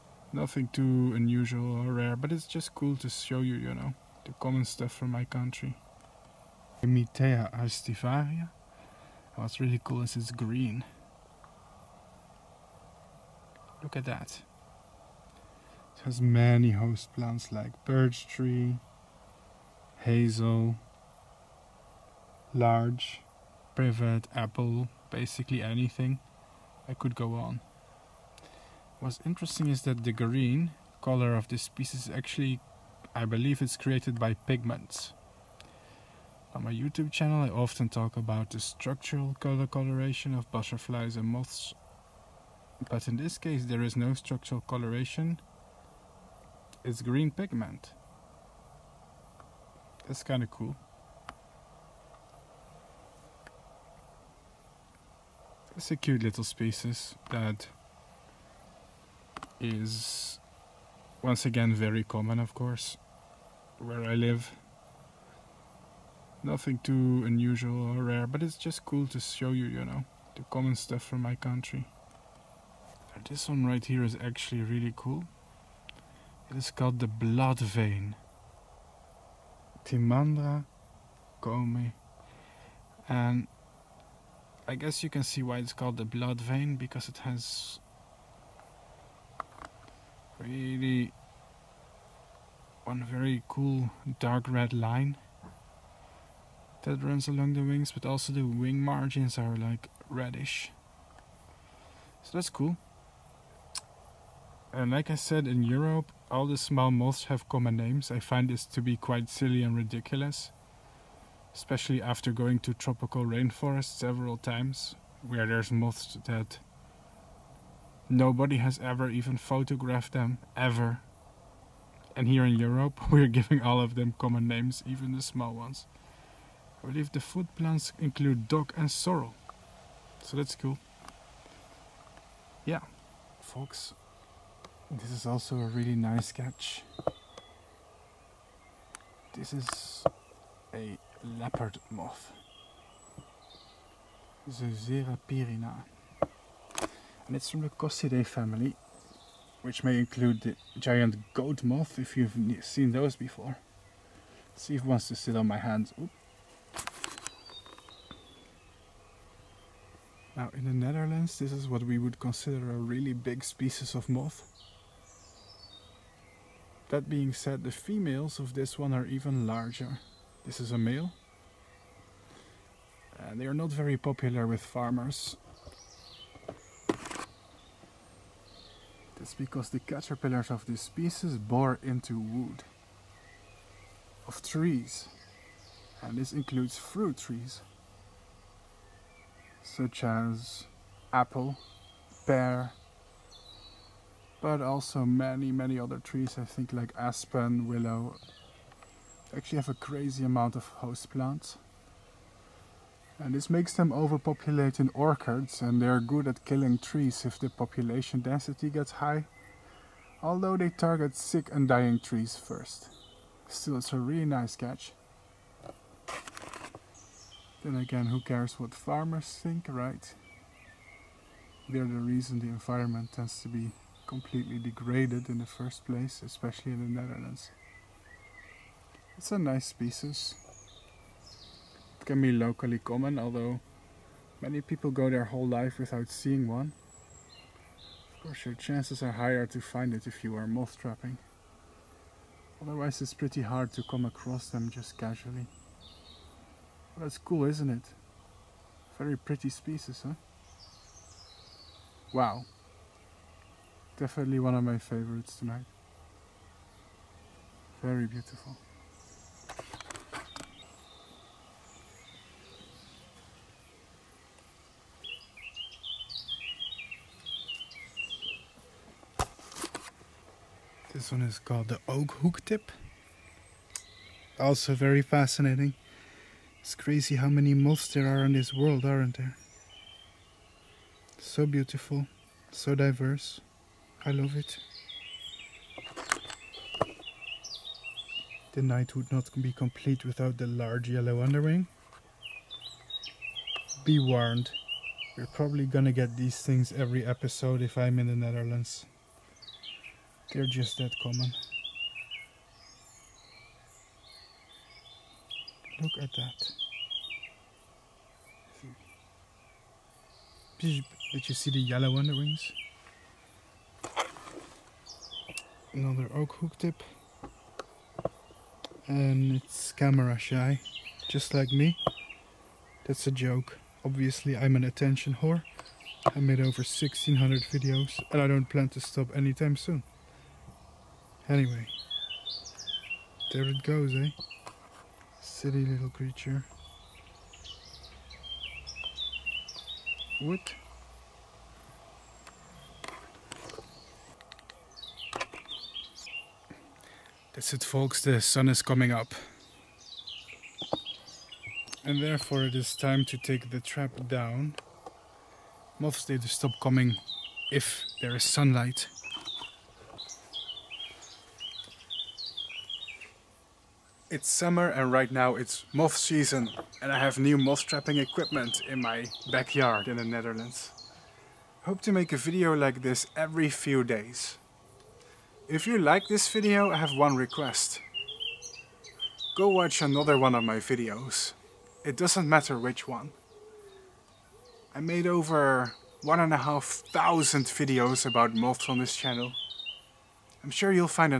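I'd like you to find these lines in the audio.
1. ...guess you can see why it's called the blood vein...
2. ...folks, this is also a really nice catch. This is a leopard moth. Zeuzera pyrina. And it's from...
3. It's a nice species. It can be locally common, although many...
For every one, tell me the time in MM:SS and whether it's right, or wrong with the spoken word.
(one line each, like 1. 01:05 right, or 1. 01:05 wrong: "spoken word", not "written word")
1. 01:24 right
2. 02:13 right
3. 03:49 right.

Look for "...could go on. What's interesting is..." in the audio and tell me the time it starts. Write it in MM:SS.
00:26.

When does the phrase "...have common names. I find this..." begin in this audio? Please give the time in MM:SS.
01:47.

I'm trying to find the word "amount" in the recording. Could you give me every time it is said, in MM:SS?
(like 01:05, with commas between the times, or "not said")
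03:20.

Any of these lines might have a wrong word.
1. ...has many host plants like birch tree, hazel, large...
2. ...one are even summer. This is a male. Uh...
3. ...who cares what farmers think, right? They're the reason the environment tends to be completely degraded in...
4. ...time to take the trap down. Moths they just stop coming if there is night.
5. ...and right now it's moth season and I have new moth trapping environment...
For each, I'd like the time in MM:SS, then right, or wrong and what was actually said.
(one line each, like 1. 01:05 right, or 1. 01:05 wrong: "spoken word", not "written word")
1. 00:16 right
2. 02:48 wrong: "larger", not "summer"
3. 03:38 right
4. 05:52 wrong: "sunlight", not "night"
5. 06:04 wrong: "equipment", not "environment".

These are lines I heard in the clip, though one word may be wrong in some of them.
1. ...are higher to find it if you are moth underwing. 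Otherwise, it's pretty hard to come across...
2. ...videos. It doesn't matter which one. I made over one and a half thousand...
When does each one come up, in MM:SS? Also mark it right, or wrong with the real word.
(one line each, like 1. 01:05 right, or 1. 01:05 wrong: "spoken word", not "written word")
1. 03:59 wrong: "trapping", not "underwing"
2. 06:20 right.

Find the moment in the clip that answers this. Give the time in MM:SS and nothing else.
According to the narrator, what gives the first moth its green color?
00:34.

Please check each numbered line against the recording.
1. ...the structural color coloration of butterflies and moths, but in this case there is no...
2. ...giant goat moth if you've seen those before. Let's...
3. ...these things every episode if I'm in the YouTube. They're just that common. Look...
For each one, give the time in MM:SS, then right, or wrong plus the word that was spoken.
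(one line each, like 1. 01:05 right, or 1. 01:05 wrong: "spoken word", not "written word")
1. 00:38 right
2. 02:30 right
3. 04:56 wrong: "Netherlands", not "YouTube".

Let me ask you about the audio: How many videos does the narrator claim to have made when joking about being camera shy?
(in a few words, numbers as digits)
1600.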